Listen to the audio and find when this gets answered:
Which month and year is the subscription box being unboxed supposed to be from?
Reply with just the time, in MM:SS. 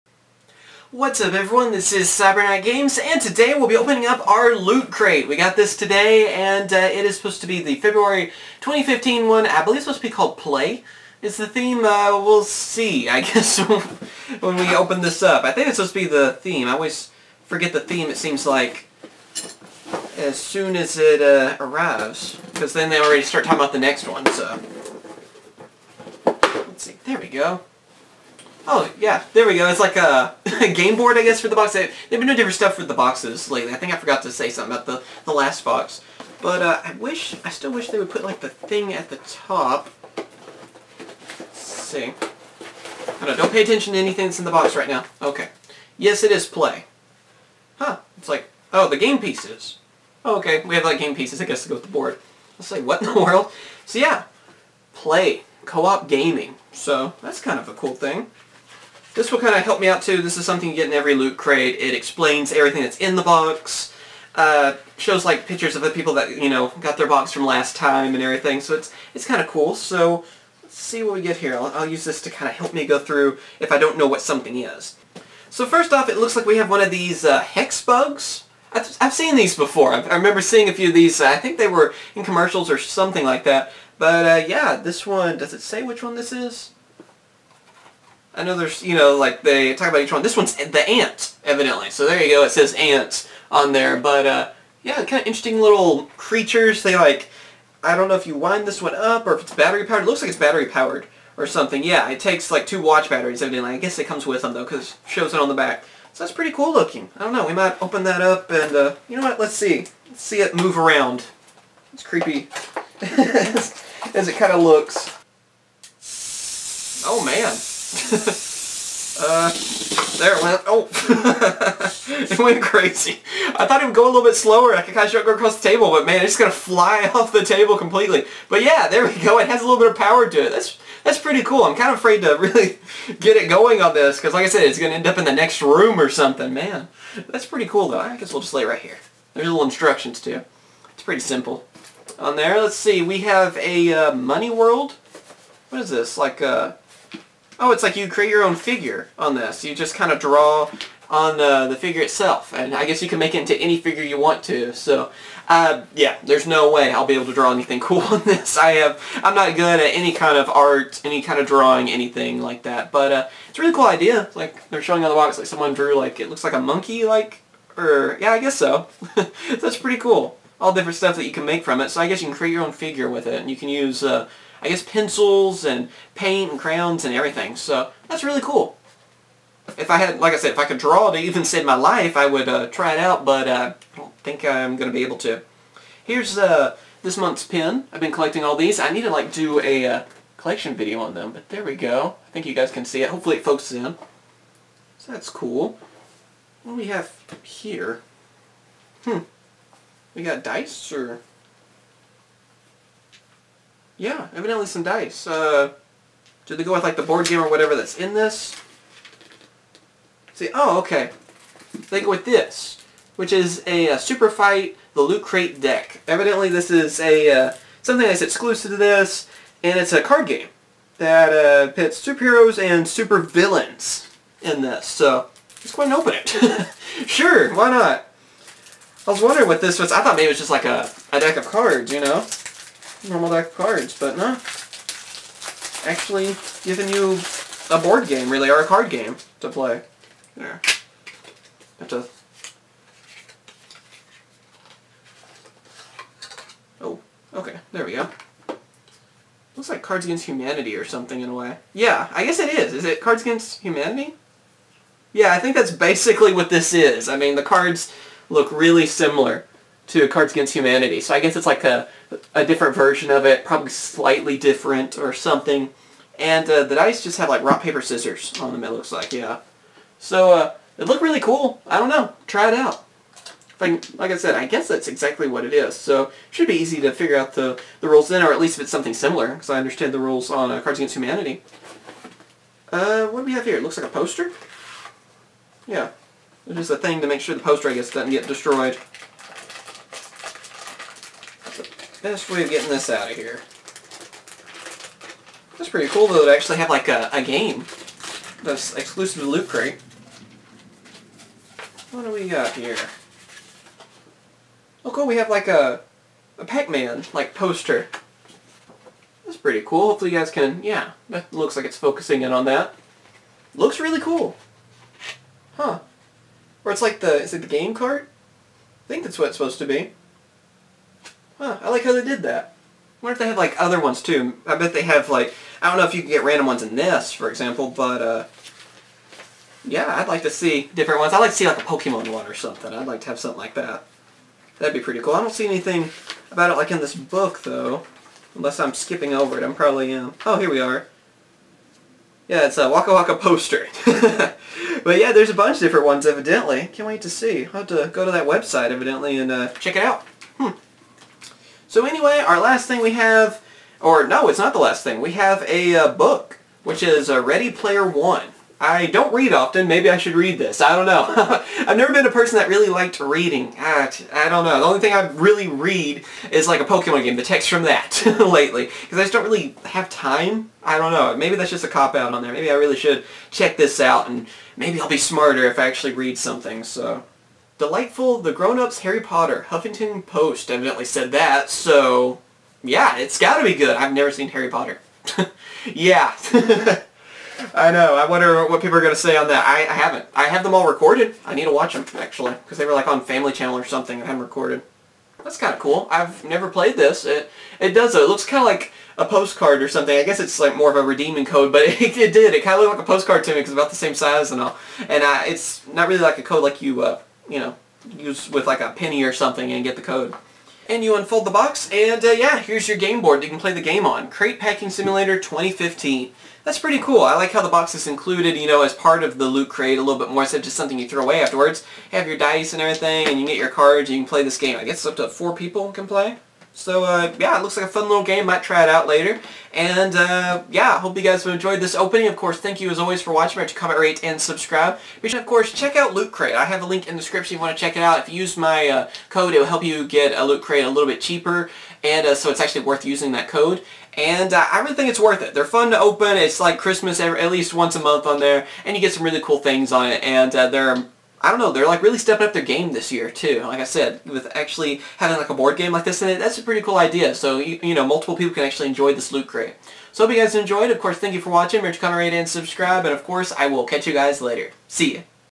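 00:07.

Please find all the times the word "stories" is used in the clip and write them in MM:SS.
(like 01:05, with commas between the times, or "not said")
not said.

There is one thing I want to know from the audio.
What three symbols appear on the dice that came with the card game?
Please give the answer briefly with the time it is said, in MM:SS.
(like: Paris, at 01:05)
Rock, paper, scissors, at 04:27.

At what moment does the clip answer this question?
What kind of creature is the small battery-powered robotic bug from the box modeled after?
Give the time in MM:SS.
01:30.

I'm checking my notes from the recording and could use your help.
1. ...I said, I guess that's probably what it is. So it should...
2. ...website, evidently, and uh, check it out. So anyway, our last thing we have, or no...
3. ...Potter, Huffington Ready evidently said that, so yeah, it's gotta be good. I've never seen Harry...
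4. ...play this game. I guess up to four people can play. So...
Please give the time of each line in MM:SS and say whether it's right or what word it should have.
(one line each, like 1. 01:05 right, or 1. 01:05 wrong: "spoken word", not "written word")
1. 04:34 wrong: "exactly", not "probably"
2. 05:48 right
3. 06:19 wrong: "Post", not "Ready"
4. 07:04 right.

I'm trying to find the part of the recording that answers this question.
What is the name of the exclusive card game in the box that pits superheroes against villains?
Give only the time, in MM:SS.
03:33.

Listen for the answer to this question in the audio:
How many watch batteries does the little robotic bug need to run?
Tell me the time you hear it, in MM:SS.
01:42.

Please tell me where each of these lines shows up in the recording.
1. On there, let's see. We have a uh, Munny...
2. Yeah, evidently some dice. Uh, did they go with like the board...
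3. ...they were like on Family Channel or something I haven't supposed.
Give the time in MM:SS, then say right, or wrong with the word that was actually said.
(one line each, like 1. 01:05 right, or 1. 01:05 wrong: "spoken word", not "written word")
1. 02:22 right
2. 03:24 right
3. 06:32 wrong: "recorded", not "supposed".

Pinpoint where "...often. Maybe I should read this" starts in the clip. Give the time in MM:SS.
05:59.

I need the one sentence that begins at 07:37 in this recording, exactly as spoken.
So, you, you know, multiple people can actually enjoy this loot crate.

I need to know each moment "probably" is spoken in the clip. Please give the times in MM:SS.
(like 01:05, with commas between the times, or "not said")
04:23, 05:39.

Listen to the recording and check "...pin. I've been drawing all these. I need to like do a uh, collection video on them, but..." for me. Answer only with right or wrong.
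wrong.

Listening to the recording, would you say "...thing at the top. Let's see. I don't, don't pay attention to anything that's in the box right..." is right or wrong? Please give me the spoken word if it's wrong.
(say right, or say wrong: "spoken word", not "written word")
right.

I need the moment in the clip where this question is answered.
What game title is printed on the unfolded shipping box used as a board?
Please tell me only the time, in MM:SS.
06:54.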